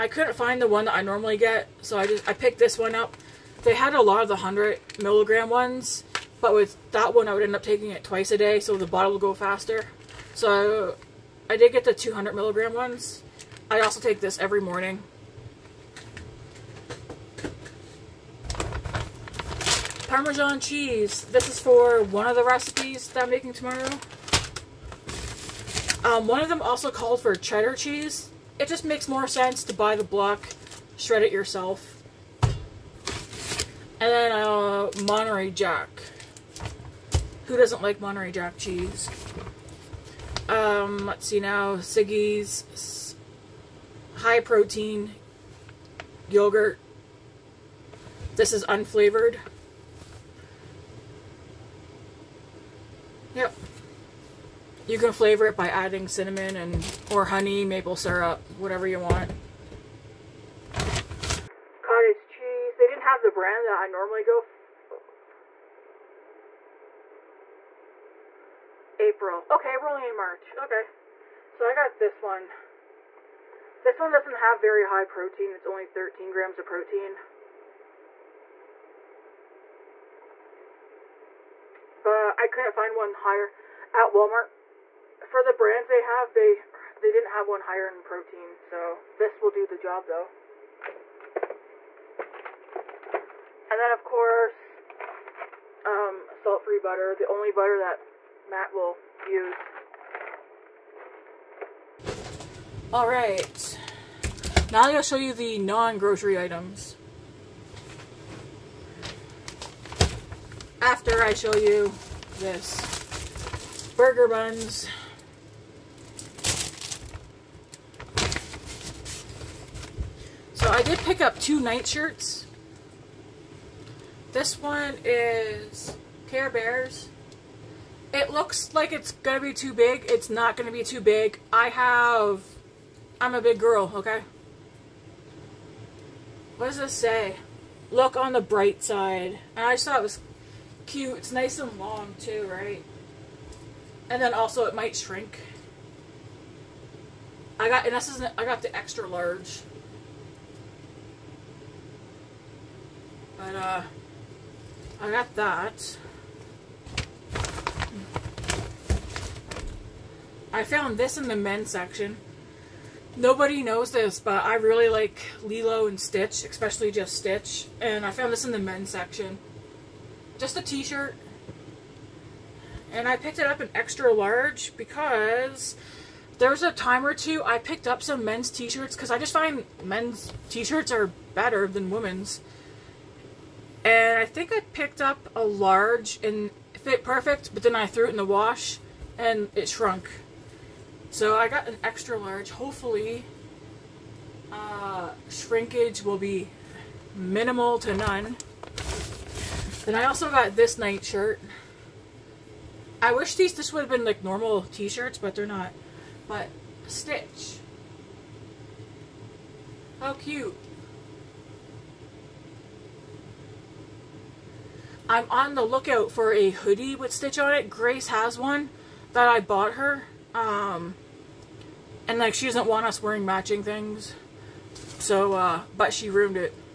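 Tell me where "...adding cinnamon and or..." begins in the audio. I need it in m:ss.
0:55.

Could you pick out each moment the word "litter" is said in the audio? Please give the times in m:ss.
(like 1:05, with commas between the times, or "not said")
not said.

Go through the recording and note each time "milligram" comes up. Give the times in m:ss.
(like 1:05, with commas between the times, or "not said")
0:05, 0:12.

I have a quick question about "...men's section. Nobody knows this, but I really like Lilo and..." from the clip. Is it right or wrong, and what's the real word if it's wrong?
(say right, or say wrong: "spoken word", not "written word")
right.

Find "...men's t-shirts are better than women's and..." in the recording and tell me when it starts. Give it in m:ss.
2:59.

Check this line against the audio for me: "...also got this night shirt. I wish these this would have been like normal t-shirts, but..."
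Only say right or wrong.
right.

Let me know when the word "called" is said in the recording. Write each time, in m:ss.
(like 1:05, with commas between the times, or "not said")
0:26.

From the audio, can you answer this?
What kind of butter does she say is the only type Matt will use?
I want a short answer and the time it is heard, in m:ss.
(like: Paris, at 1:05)
Salt-free butter, at 1:36.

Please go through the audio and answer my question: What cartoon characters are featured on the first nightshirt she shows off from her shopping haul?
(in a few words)
Care Bears.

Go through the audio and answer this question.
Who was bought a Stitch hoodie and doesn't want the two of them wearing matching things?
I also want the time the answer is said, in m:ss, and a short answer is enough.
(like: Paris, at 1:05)
Grace, at 3:37.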